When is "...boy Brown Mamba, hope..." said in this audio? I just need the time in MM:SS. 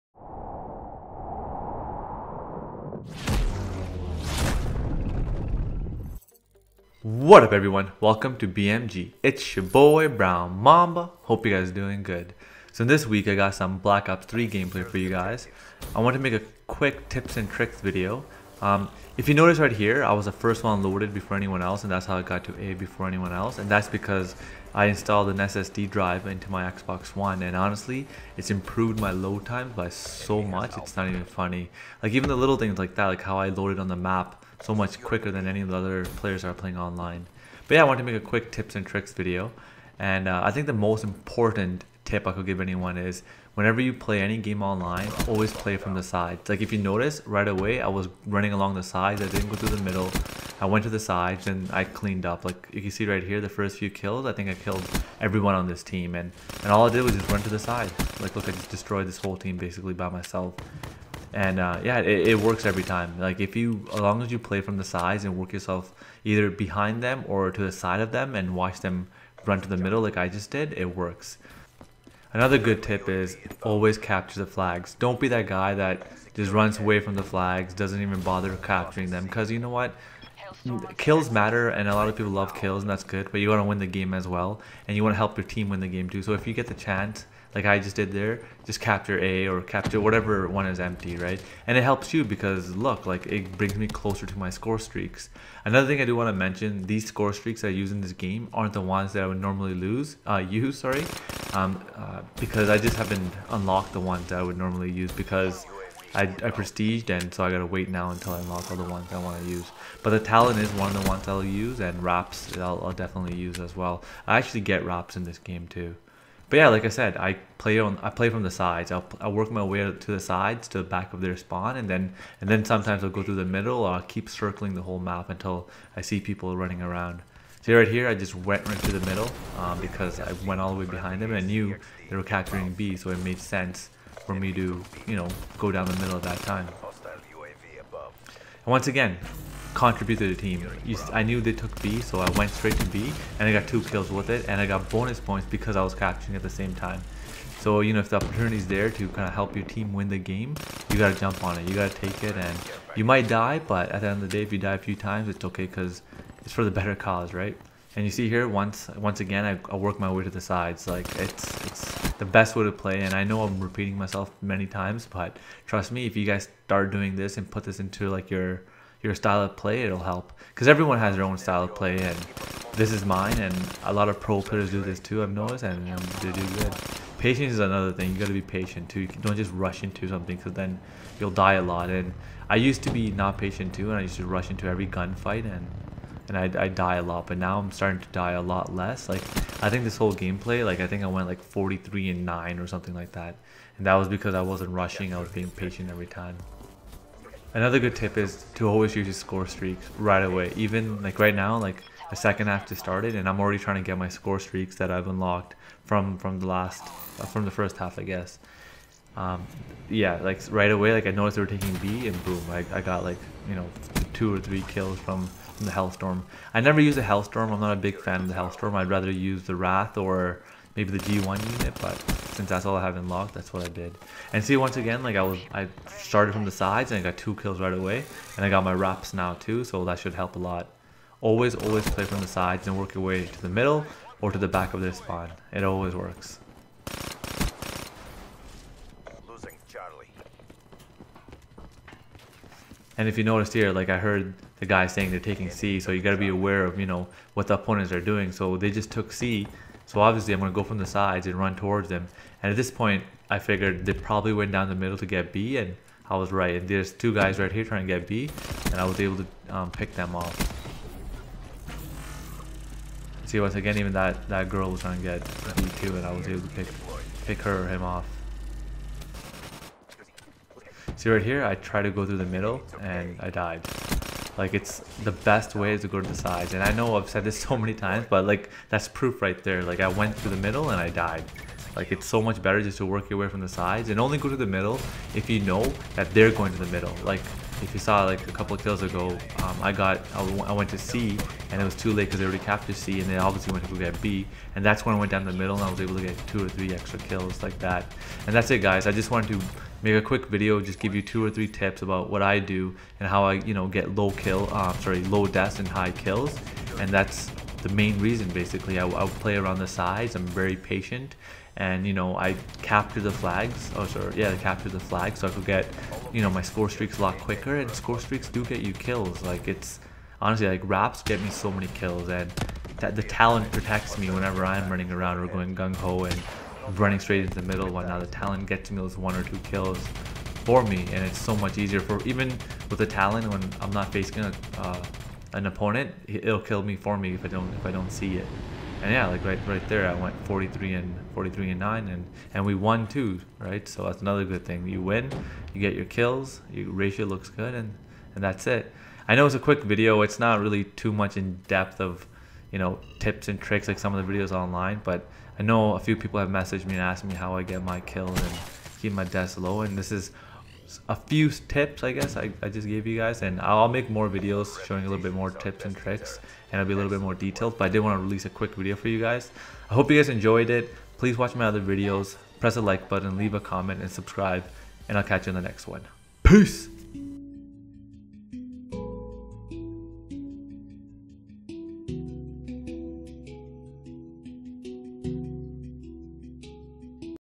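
00:09.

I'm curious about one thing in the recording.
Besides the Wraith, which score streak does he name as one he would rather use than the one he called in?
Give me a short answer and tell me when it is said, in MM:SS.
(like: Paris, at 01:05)
G.I. Unit, at 03:40.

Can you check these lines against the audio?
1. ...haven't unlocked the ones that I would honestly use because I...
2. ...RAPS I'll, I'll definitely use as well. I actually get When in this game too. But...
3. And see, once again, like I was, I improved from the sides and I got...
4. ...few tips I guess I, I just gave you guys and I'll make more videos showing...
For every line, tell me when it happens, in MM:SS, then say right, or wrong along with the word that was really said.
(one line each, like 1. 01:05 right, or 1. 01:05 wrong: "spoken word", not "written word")
1. 01:42 wrong: "normally", not "honestly"
2. 01:52 wrong: "RAPS", not "When"
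3. 03:44 wrong: "started", not "improved"
4. 06:00 right.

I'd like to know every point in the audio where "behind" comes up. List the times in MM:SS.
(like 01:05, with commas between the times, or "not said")
01:06, 02:10.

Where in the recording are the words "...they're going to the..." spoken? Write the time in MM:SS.
04:46.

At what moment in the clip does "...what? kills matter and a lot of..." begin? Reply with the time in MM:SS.
01:19.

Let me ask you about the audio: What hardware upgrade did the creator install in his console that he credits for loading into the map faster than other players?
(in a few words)
SSD drive.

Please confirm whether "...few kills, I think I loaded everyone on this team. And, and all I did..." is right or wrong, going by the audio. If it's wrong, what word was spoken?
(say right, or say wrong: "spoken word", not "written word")
wrong: "killed", not "loaded".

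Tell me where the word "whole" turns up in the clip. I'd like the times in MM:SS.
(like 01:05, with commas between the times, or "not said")
00:59, 02:04, 03:09.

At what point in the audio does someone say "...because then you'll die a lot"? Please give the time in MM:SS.
03:00.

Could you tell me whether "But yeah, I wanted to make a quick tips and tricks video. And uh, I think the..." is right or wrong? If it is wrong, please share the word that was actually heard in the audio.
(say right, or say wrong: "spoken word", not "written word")
right.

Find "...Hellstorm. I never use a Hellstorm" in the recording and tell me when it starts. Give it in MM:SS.
03:35.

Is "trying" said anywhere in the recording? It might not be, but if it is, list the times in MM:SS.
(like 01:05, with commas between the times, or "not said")
03:23, 04:17, 04:24.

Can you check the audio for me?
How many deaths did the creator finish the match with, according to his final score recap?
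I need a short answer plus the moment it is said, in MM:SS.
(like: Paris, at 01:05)
9, at 05:41.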